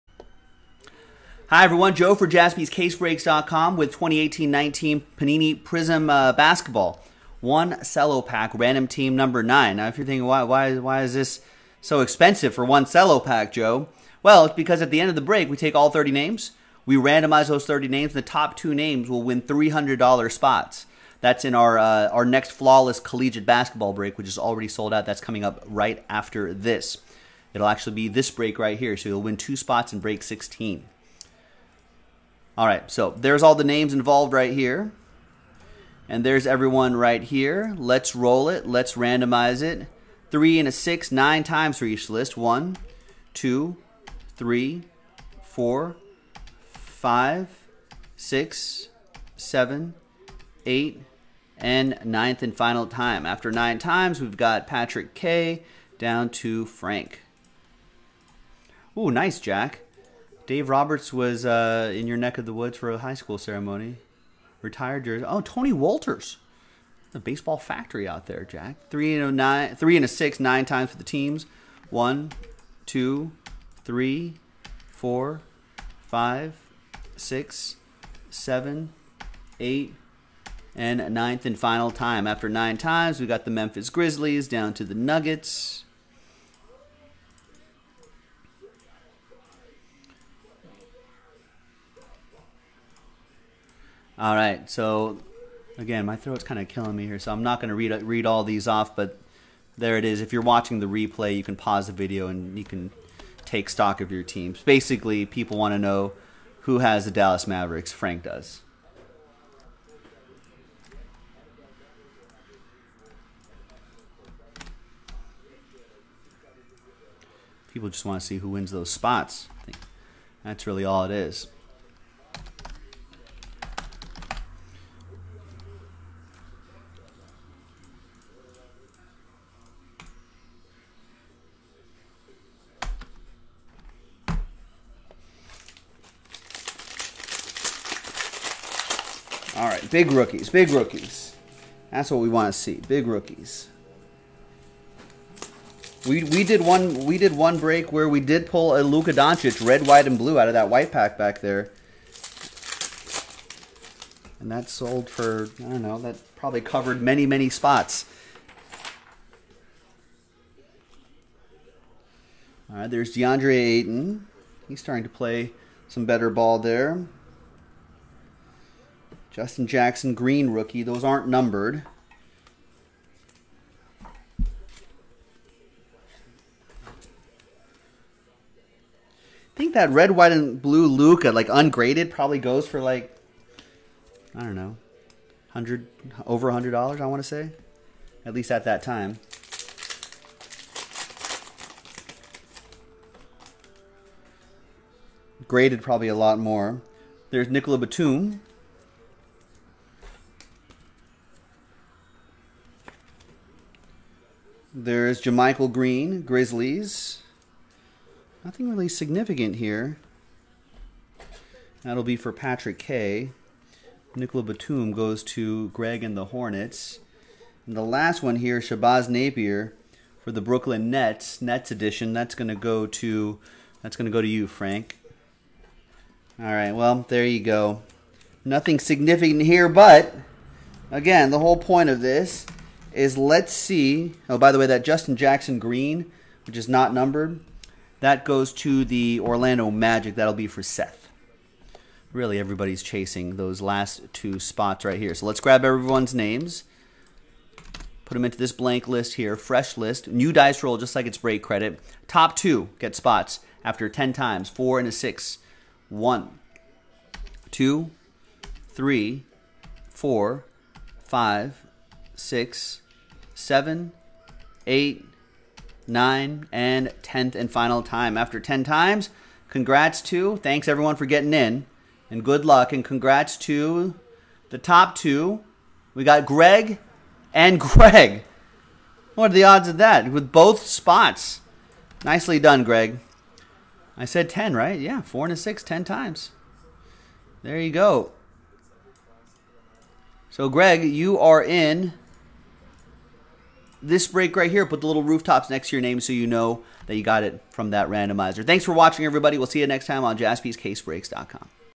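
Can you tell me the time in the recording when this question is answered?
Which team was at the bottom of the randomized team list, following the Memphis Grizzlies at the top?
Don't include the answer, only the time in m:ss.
1:24.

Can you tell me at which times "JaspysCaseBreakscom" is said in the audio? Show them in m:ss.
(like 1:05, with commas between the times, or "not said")
0:02, 5:00.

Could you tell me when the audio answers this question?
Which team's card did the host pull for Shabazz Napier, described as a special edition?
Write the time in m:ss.
3:40.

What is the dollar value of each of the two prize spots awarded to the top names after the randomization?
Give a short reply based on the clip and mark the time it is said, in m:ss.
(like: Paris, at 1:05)
$300, at 0:19.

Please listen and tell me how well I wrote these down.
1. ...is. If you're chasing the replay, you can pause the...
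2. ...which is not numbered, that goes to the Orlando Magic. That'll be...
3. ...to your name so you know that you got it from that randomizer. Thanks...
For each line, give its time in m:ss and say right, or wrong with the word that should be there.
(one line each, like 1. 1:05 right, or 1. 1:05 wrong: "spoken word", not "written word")
1. 1:40 wrong: "watching", not "chasing"
2. 3:56 right
3. 4:55 right.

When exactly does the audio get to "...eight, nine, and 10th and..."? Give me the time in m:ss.
4:24.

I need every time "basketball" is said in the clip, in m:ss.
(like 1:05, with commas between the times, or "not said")
0:06, 0:23.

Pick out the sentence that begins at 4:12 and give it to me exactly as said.
Top two get spots after 10 times, four and a six.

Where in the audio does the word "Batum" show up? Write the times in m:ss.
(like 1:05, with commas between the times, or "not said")
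3:17, 3:34.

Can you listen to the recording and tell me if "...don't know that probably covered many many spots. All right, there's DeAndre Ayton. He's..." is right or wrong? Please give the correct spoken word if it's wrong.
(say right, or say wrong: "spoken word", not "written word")
right.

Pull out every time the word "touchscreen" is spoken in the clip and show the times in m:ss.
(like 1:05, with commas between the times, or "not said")
not said.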